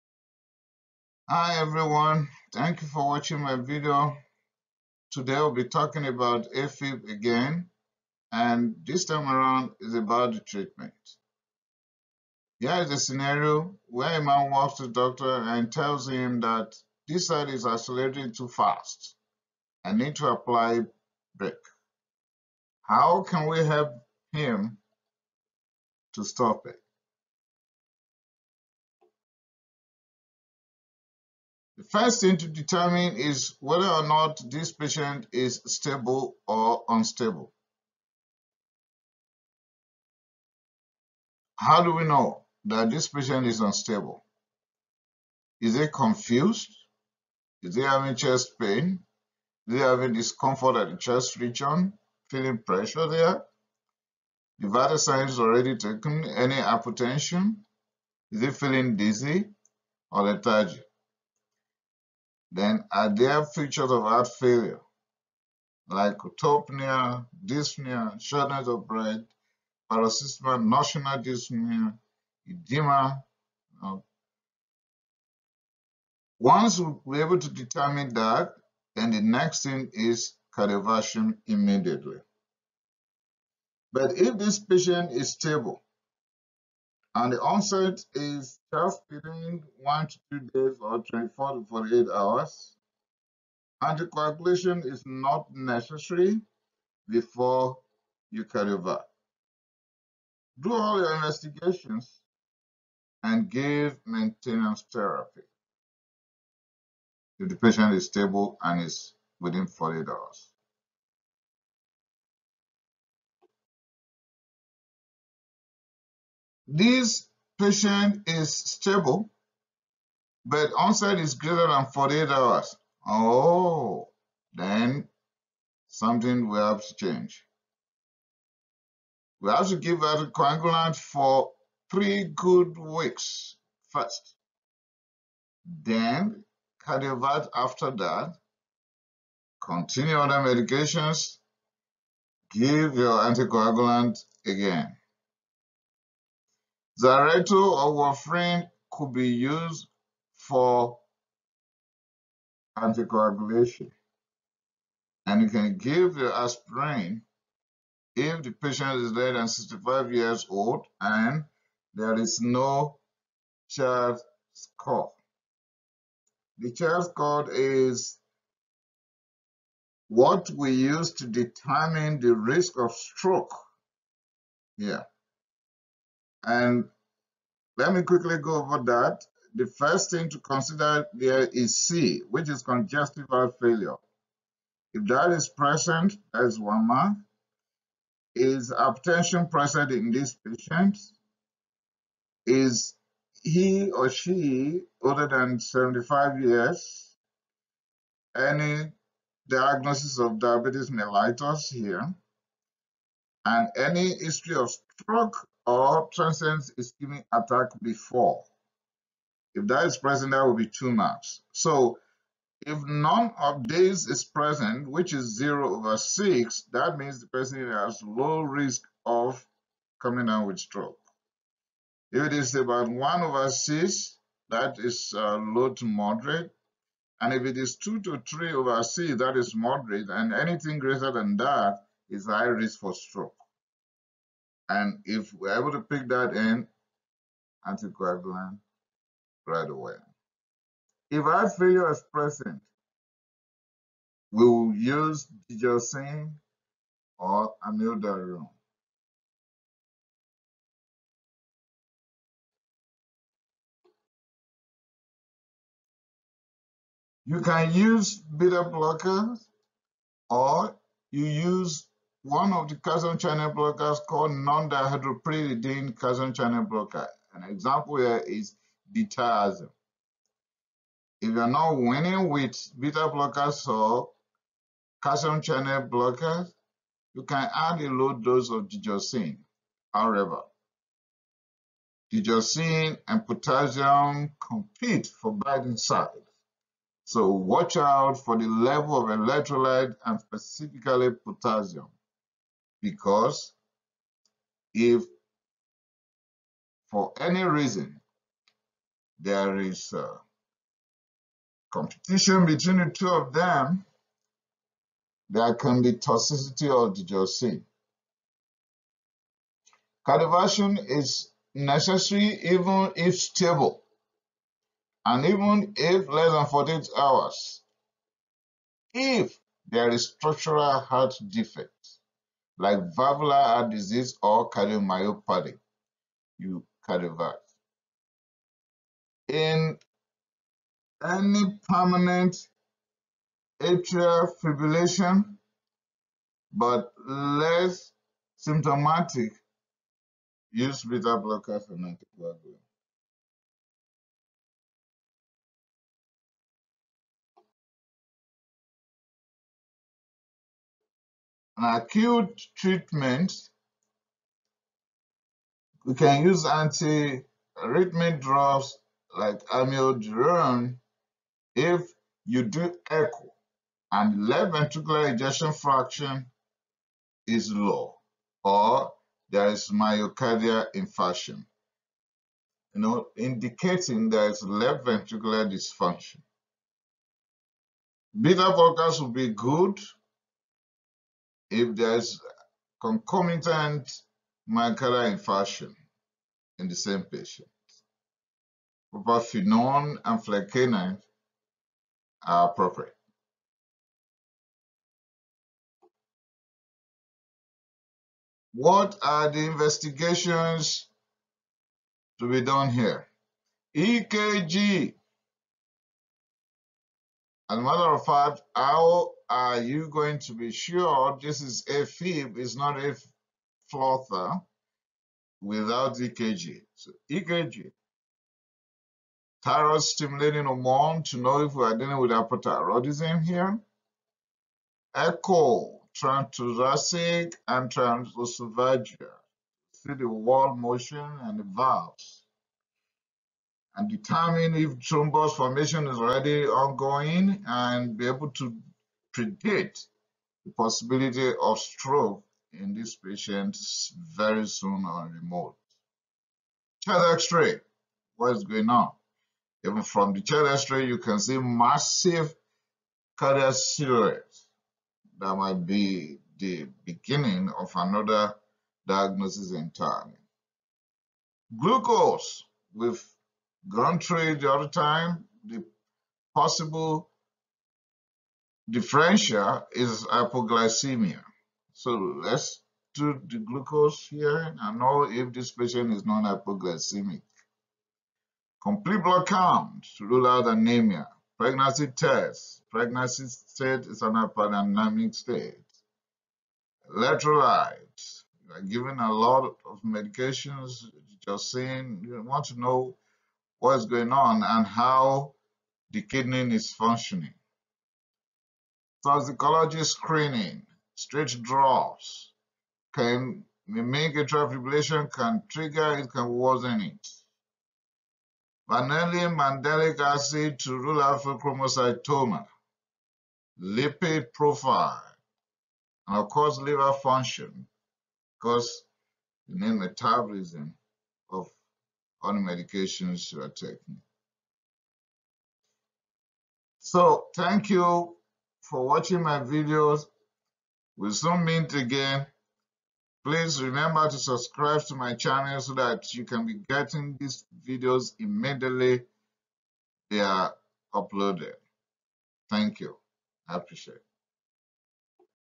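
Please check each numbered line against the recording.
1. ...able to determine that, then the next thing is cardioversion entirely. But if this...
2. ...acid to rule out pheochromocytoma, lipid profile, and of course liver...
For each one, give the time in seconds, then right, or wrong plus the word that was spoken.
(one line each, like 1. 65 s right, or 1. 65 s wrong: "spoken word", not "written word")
1. 77 s wrong: "immediately", not "entirely"
2. 509 s right.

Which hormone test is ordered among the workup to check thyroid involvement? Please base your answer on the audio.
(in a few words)
Thyroid stimulating hormone.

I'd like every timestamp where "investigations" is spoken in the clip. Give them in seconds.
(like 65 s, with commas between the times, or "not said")
101 s, 399 s.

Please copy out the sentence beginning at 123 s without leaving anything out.
Oh, then something will have to change.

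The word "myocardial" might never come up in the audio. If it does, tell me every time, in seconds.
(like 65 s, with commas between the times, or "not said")
369 s, 384 s.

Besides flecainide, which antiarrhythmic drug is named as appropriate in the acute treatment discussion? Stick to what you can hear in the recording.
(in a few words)
Propafenone.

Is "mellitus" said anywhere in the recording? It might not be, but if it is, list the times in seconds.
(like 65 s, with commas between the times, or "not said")
200 s.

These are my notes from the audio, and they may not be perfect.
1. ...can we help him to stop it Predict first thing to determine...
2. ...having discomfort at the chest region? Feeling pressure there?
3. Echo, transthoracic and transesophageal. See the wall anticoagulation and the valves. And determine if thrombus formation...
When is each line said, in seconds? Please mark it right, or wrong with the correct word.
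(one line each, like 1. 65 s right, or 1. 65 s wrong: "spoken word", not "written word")
1. 23 s wrong: "The", not "Predict"
2. 49 s right
3. 424 s wrong: "motion", not "anticoagulation".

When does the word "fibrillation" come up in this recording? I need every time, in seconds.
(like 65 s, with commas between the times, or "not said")
334 s, 504 s.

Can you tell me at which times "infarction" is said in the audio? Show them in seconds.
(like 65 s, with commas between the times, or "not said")
370 s, 385 s.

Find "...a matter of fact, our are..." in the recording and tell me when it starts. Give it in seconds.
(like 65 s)
407 s.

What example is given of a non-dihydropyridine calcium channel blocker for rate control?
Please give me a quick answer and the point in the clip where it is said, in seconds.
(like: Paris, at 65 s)
Diltiazem, at 268 s.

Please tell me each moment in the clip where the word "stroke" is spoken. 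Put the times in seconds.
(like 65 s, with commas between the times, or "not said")
172 s, 204 s, 220 s, 232 s, 441 s.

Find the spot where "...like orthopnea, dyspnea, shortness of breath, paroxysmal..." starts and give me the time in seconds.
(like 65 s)
65 s.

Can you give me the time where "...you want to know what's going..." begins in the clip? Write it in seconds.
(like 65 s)
492 s.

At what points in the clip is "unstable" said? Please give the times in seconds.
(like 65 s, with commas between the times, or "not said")
36 s, 43 s.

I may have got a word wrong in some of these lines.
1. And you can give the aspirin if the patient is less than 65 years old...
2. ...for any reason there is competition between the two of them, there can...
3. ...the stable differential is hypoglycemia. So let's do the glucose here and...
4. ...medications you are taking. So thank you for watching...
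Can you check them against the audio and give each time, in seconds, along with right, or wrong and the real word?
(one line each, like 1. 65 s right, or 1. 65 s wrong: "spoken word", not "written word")
1. 155 s right
2. 296 s right
3. 465 s wrong: "possible", not "stable"
4. 522 s right.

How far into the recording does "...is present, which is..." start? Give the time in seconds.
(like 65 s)
214 s.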